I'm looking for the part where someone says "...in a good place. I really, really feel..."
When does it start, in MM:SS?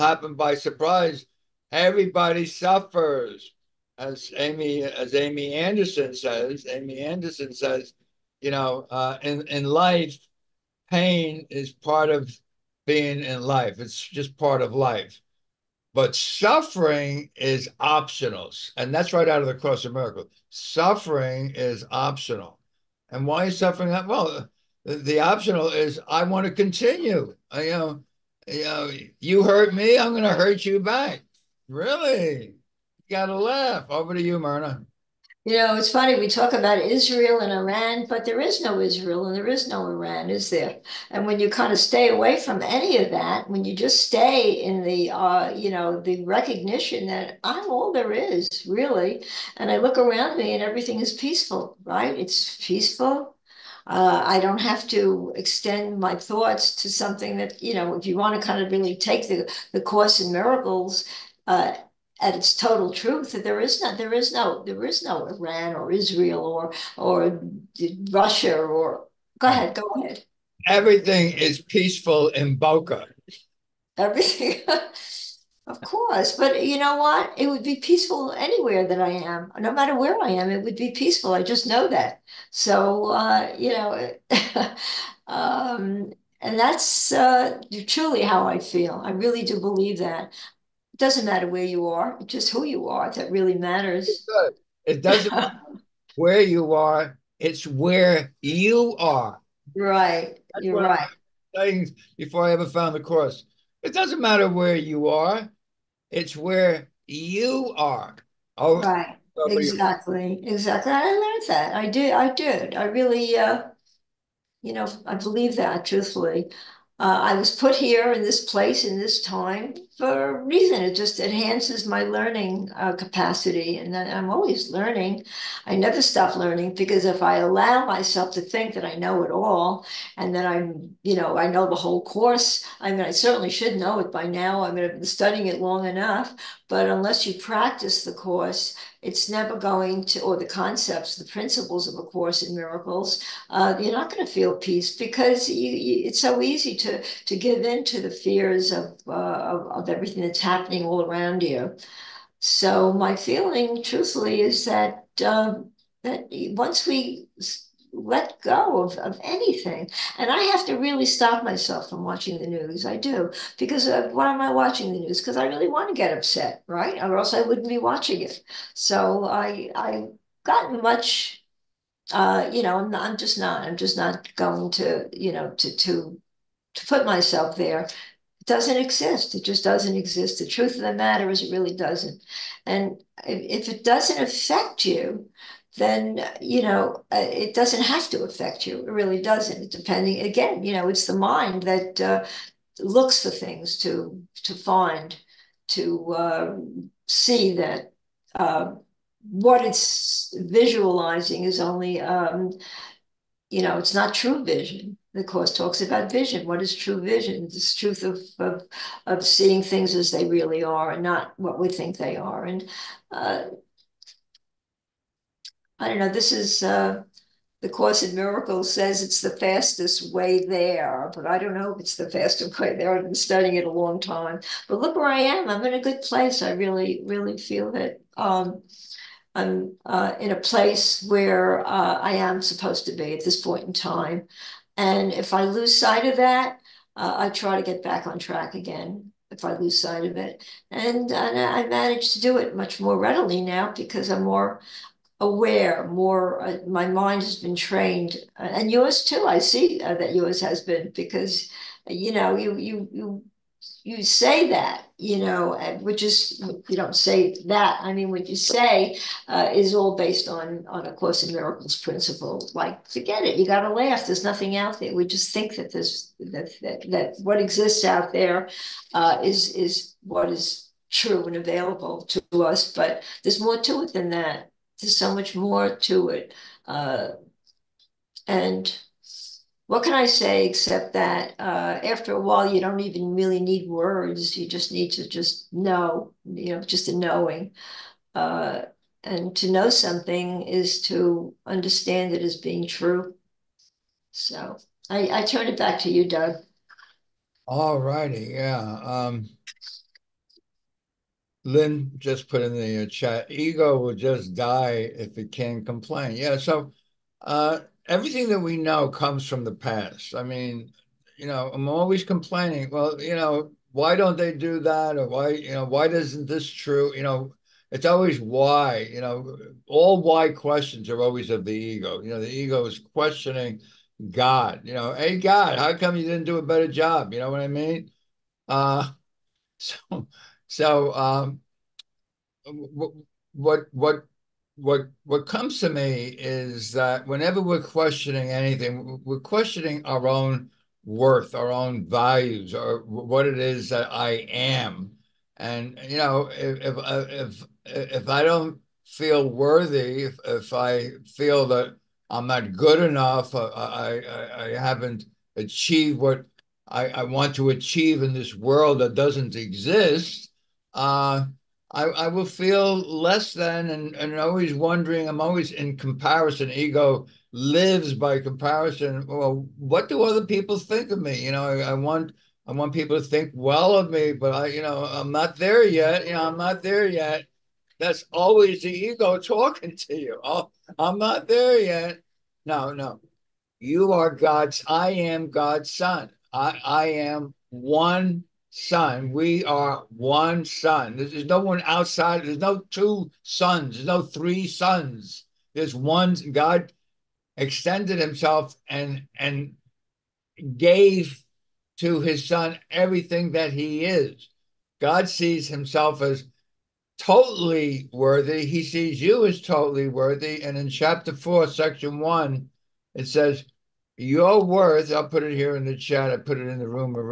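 03:45.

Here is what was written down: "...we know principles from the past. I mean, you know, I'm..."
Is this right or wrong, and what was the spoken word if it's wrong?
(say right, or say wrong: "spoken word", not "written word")
wrong: "comes", not "principles".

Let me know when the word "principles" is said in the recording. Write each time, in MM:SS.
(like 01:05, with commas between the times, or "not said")
02:21, 04:21.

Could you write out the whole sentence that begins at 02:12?
I mean, I certainly should know it by now.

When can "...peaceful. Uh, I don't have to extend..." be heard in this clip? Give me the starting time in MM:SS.
00:52.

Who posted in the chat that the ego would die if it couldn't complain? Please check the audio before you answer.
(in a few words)
Lynn.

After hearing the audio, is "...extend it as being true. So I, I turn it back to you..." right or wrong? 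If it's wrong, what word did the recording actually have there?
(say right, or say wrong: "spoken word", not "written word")
wrong: "understand", not "extend".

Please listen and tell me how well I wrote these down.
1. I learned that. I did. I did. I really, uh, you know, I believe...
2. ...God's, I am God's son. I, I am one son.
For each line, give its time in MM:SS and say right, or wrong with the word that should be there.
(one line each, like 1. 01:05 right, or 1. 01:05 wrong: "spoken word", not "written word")
1. 01:50 right
2. 06:24 right.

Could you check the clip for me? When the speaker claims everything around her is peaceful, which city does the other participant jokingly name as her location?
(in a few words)
Boca.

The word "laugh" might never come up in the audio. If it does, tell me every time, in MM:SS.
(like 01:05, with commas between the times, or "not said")
00:33, 04:23.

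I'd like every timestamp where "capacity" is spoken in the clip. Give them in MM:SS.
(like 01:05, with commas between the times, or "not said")
02:02.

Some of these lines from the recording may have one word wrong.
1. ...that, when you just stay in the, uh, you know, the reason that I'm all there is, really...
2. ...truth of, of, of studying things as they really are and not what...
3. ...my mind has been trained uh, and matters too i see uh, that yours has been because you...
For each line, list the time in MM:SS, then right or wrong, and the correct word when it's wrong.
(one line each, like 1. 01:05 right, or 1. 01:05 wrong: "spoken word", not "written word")
1. 00:43 wrong: "recognition", not "reason"
2. 03:27 wrong: "seeing", not "studying"
3. 04:06 wrong: "yours", not "matters".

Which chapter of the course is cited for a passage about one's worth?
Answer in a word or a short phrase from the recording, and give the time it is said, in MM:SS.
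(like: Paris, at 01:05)
4, at 06:50.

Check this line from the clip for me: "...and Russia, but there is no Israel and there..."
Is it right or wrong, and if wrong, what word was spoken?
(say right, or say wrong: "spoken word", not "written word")
wrong: "Iran", not "Russia".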